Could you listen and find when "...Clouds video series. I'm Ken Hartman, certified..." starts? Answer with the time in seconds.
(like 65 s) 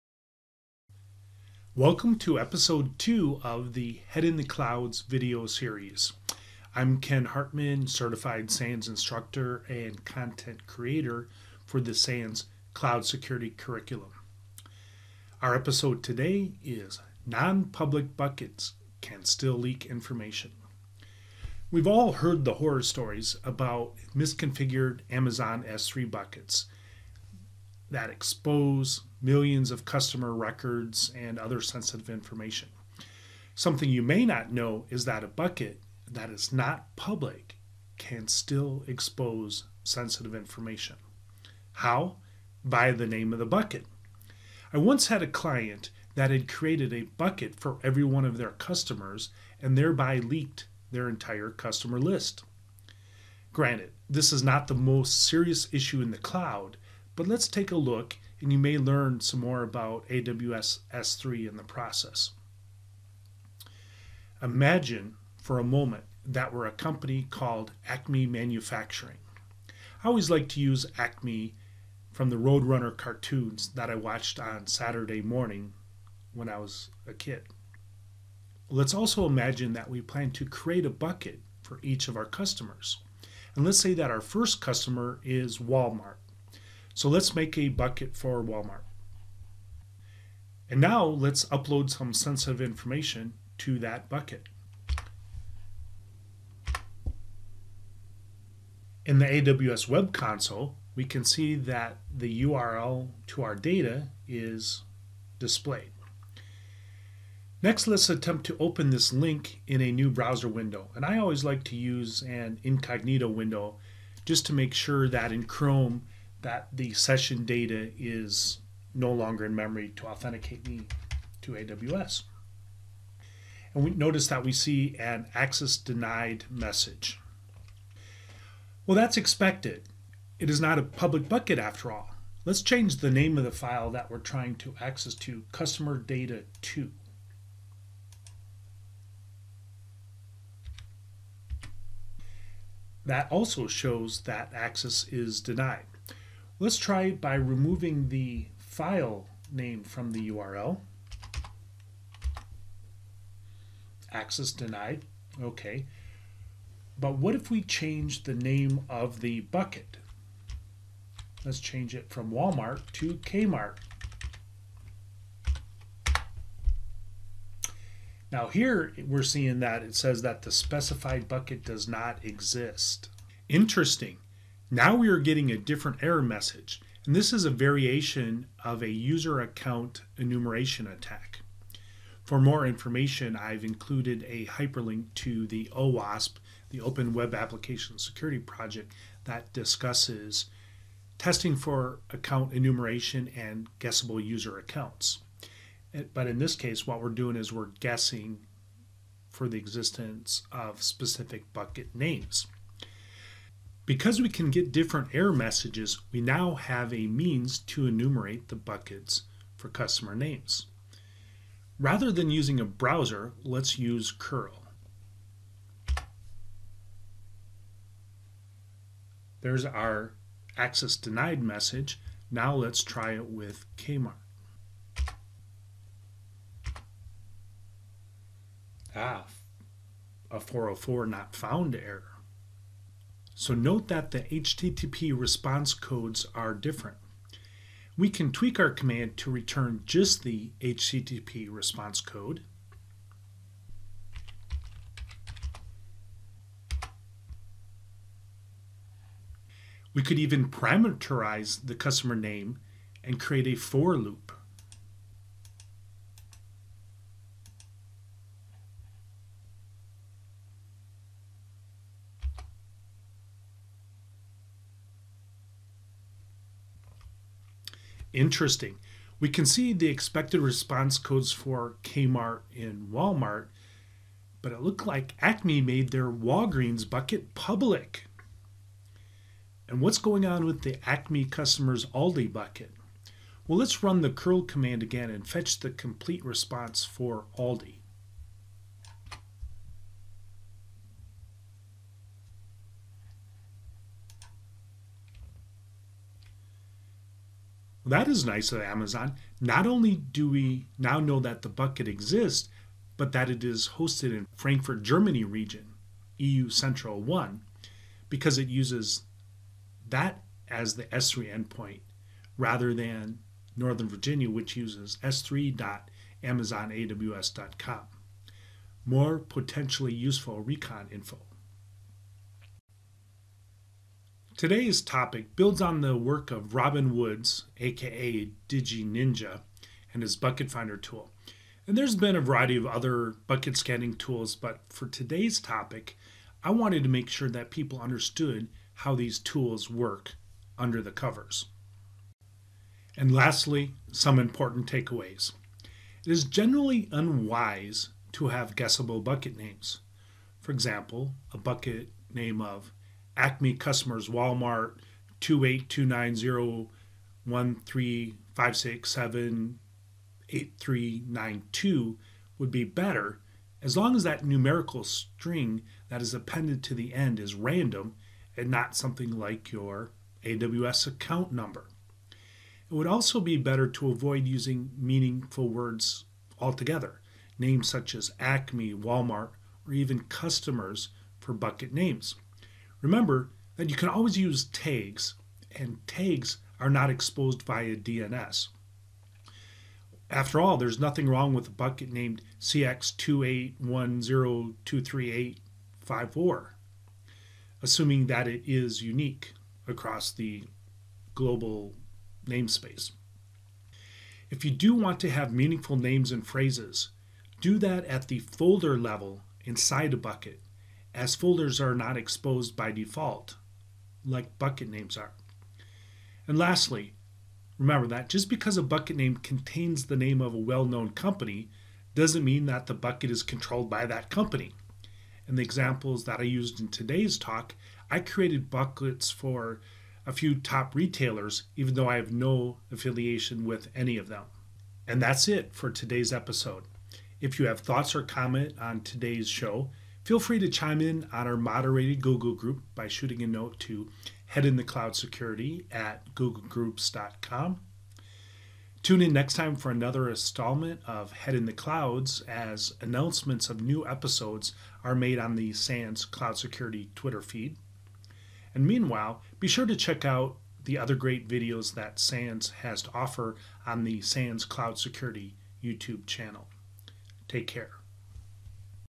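4 s.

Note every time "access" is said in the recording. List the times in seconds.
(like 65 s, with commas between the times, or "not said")
125 s, 134 s, 144 s, 154 s, 220 s.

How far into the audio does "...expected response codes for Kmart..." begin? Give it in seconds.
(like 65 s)
269 s.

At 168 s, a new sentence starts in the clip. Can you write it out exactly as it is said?
Now here we're seeing that it says that the specified bucket does not exist.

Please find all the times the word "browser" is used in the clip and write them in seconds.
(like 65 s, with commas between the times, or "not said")
110 s, 212 s.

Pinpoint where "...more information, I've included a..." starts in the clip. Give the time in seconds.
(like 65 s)
182 s.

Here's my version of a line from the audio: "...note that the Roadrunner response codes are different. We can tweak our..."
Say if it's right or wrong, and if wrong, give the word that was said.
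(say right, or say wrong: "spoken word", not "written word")
wrong: "HTTP", not "Roadrunner".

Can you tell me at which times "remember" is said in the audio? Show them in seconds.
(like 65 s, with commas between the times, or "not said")
382 s, 417 s.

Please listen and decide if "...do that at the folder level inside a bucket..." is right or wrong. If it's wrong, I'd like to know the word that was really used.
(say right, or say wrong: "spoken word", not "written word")
right.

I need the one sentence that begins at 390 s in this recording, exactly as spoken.
After all, there's nothing wrong with a bucket named CX281023854, assuming that it is unique across the global namespace.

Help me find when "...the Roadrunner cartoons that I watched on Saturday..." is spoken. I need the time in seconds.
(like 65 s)
72 s.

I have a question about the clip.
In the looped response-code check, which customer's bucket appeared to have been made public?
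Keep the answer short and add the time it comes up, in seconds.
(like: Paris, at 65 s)
Walgreens, at 276 s.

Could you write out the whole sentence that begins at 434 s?
And that's it for today's episode.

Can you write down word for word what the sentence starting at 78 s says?
Let's also imagine that we plan to create a bucket for each of our customers.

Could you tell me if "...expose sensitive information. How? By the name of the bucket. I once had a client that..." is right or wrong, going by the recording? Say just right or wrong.
right.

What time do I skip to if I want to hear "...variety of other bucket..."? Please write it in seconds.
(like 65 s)
332 s.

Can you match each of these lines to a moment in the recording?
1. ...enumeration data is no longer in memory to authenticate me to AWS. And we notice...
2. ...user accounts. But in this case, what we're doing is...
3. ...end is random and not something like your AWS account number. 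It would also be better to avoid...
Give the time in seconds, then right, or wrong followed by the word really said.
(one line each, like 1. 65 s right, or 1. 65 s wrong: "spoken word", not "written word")
1. 116 s wrong: "session", not "enumeration"
2. 194 s right
3. 366 s right.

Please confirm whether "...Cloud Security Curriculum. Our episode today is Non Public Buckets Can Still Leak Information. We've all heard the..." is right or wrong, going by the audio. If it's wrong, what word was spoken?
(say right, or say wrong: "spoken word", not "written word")
right.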